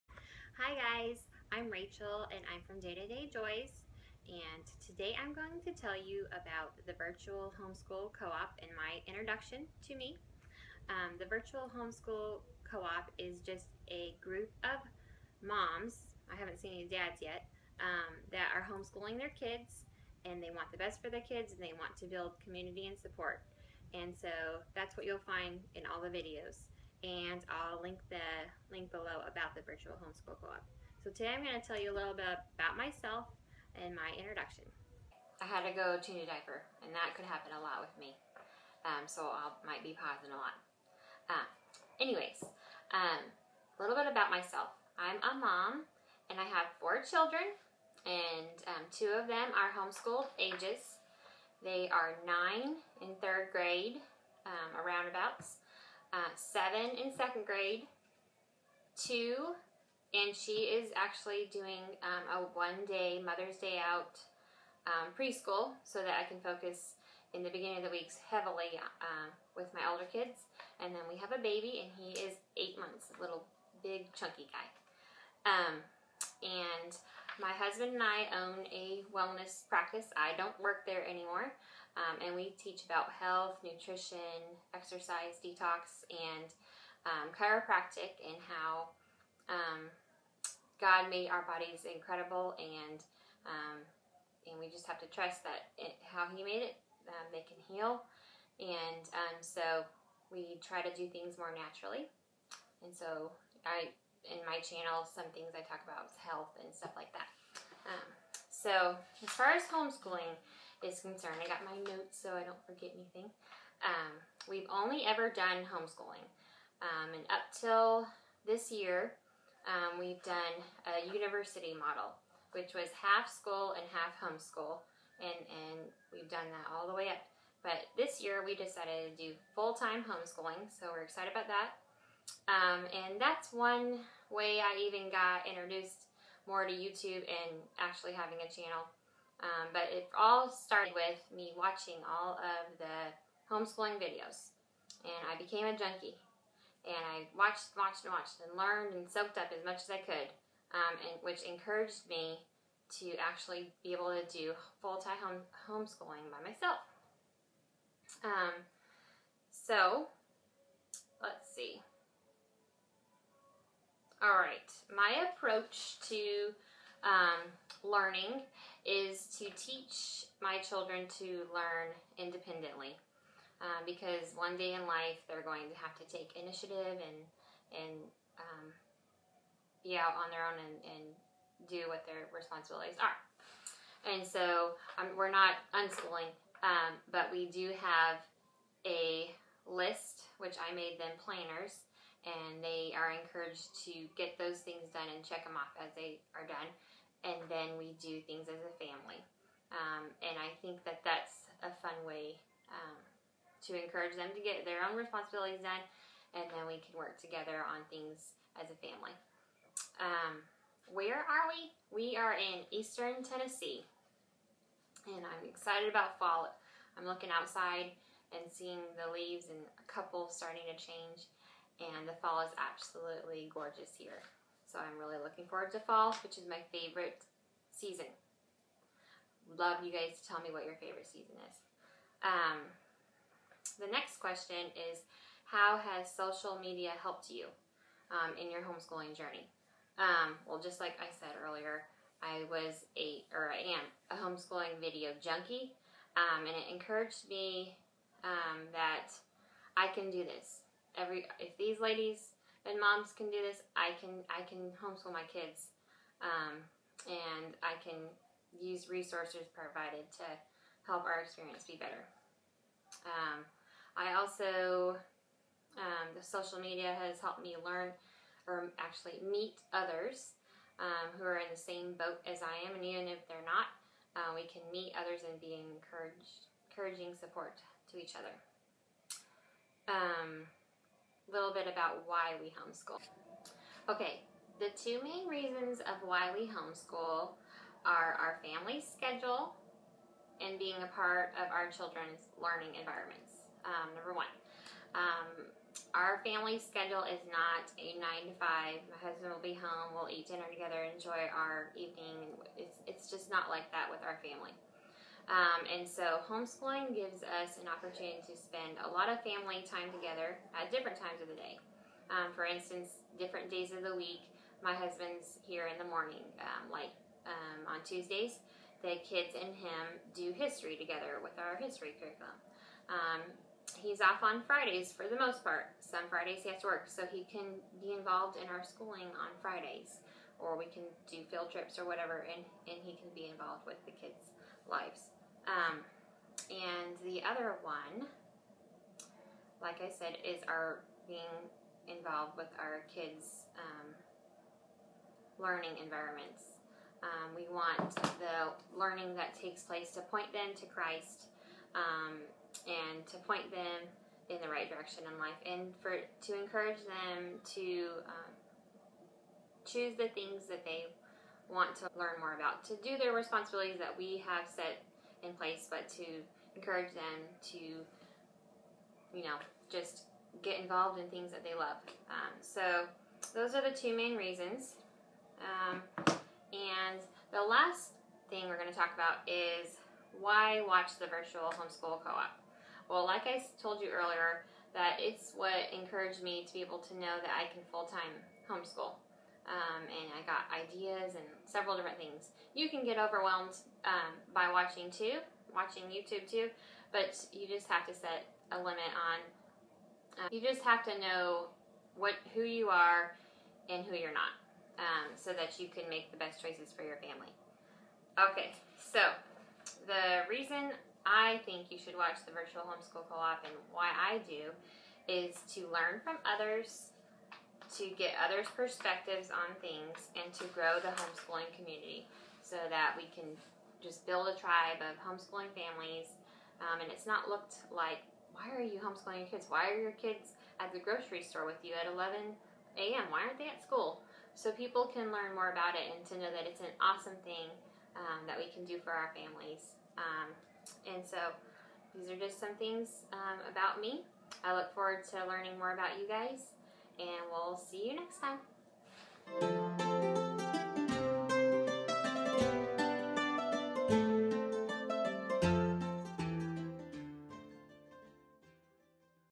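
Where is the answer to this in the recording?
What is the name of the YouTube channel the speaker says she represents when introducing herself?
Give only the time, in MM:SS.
00:02.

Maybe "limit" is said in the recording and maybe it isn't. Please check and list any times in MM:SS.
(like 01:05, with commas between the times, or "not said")
06:38.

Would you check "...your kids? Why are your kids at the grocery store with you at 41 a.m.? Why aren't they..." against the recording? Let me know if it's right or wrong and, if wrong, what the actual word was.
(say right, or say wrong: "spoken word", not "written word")
wrong: "11", not "41".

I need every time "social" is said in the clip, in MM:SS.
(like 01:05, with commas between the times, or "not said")
03:56, 04:26.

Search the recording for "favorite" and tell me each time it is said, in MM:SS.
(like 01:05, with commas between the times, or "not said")
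03:46, 03:50.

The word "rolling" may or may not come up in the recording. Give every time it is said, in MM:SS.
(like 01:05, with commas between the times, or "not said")
not said.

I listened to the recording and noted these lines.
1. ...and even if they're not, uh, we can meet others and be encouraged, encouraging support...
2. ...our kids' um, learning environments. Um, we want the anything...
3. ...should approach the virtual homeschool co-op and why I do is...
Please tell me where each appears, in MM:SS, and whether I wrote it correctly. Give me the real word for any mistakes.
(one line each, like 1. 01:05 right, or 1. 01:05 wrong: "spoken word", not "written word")
1. 04:32 right
2. 05:42 wrong: "learning", not "anything"
3. 06:51 wrong: "watch", not "approach".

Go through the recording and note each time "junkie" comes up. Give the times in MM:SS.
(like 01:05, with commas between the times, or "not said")
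02:25, 04:05.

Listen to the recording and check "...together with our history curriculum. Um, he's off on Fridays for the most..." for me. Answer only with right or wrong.
right.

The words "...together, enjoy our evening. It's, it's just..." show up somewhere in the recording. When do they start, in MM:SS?
05:00.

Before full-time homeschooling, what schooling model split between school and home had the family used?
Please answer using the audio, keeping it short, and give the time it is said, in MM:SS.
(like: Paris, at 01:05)
university model, at 02:01.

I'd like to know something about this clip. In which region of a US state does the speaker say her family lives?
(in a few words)
eastern Tennessee.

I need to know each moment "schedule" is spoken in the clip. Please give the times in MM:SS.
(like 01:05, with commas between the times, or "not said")
04:48, 04:56.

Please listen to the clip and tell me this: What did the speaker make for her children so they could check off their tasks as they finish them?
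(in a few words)
planners.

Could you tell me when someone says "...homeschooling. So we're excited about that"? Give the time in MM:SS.
02:10.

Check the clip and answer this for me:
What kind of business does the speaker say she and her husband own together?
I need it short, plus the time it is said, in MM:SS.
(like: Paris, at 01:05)
wellness practice, at 01:19.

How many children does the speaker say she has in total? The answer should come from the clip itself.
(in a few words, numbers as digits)
4.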